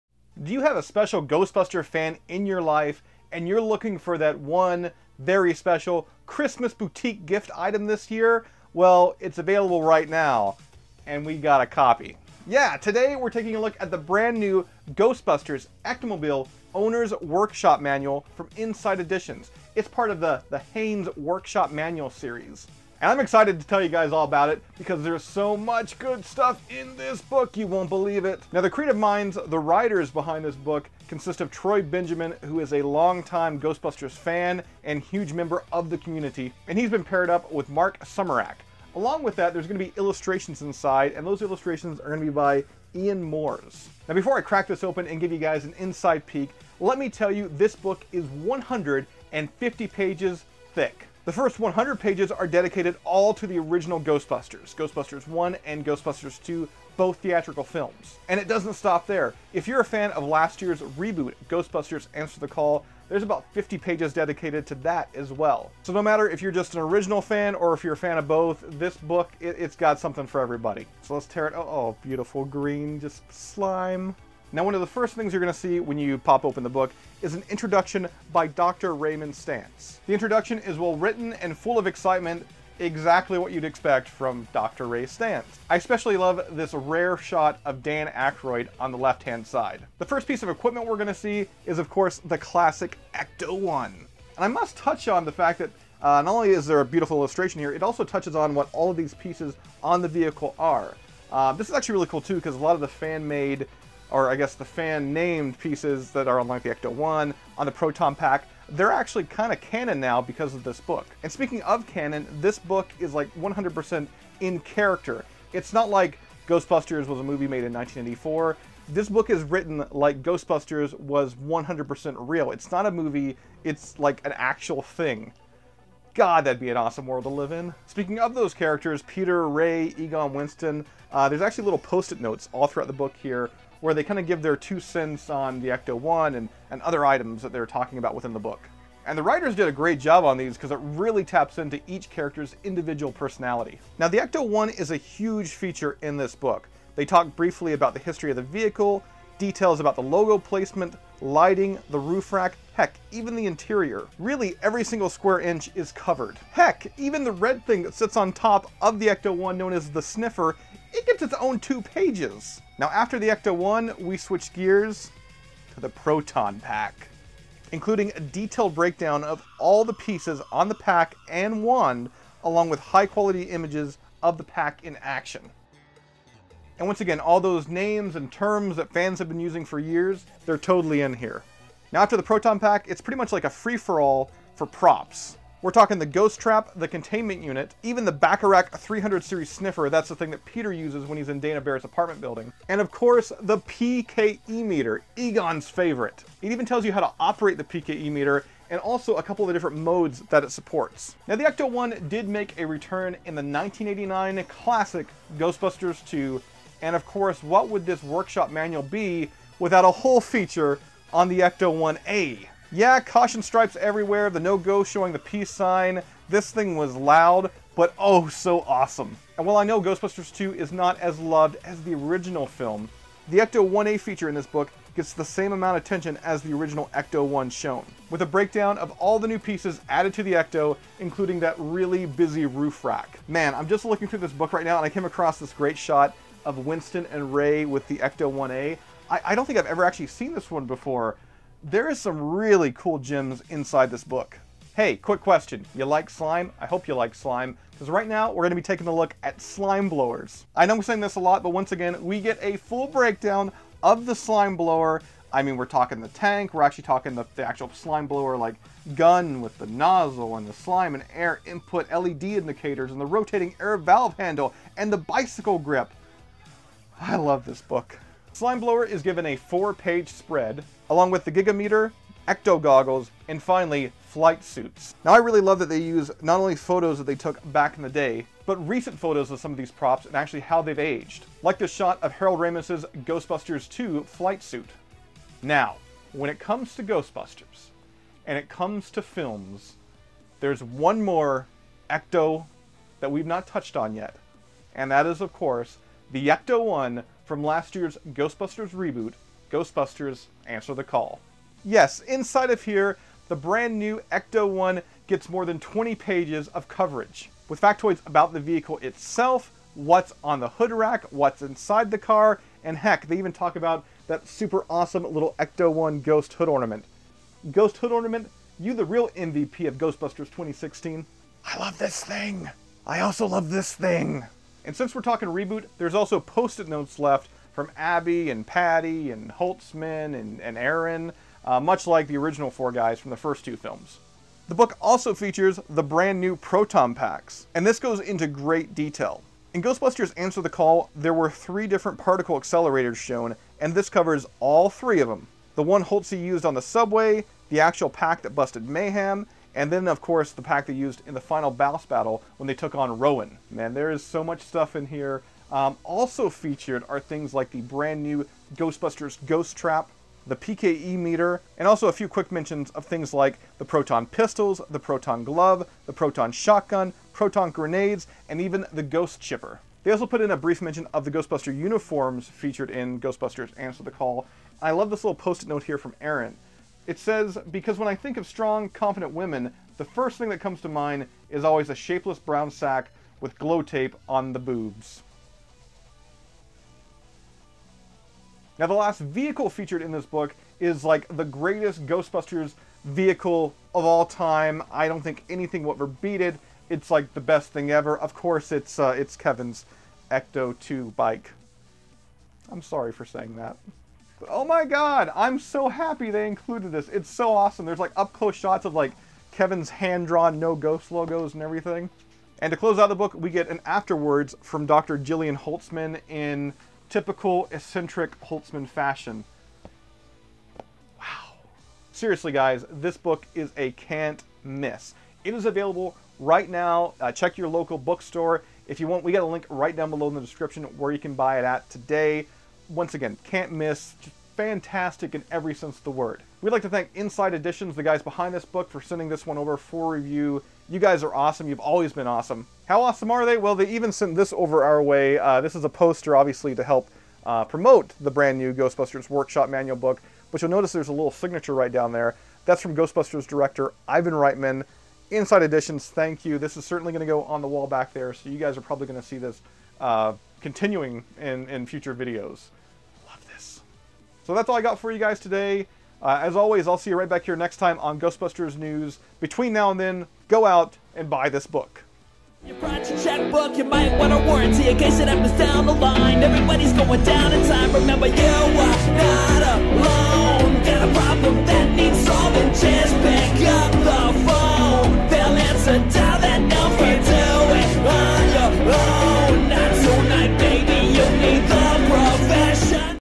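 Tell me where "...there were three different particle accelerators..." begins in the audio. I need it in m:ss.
5:40.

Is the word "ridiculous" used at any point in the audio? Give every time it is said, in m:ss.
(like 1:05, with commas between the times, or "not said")
not said.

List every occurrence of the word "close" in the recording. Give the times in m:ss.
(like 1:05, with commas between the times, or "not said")
6:48, 6:52.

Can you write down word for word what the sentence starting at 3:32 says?
Yeah, caution stripes everywhere, the no-go showing the peace sign.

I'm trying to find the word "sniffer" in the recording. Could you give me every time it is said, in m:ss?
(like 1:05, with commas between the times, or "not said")
2:40, 3:09.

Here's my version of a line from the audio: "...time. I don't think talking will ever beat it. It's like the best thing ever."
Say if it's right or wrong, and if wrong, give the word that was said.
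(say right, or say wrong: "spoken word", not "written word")
wrong: "anything", not "talking".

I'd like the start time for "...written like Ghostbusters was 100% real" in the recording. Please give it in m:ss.
1:59.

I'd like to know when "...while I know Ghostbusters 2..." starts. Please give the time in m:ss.
3:39.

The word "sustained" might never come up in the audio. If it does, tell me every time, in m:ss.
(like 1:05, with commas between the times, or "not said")
not said.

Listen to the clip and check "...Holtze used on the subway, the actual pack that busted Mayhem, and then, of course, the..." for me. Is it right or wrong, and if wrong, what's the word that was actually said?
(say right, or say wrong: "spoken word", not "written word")
right.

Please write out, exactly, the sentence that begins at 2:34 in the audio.
Really, every single square inch is covered.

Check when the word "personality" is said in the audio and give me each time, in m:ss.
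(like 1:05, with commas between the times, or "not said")
2:23.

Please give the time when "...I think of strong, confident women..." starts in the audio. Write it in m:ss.
6:17.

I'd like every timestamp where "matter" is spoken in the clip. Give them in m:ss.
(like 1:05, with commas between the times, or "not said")
1:06.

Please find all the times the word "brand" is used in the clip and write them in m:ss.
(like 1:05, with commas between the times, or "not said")
0:13, 5:03, 5:35, 5:57, 7:28.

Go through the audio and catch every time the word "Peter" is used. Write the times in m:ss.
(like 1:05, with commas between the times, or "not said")
2:09, 3:10.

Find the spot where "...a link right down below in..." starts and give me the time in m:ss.
7:09.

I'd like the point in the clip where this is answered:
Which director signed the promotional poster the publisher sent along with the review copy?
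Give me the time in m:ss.
7:33.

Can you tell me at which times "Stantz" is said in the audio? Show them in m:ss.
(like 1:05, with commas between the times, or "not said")
1:19, 1:25.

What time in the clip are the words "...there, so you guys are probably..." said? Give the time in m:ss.
7:37.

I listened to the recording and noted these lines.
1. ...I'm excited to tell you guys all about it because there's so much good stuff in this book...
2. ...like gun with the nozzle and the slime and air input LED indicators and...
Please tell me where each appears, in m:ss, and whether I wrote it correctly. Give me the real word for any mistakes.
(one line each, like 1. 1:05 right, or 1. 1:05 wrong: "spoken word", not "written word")
1. 0:23 right
2. 4:18 right.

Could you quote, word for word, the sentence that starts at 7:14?
Fantastic in every sense of the word.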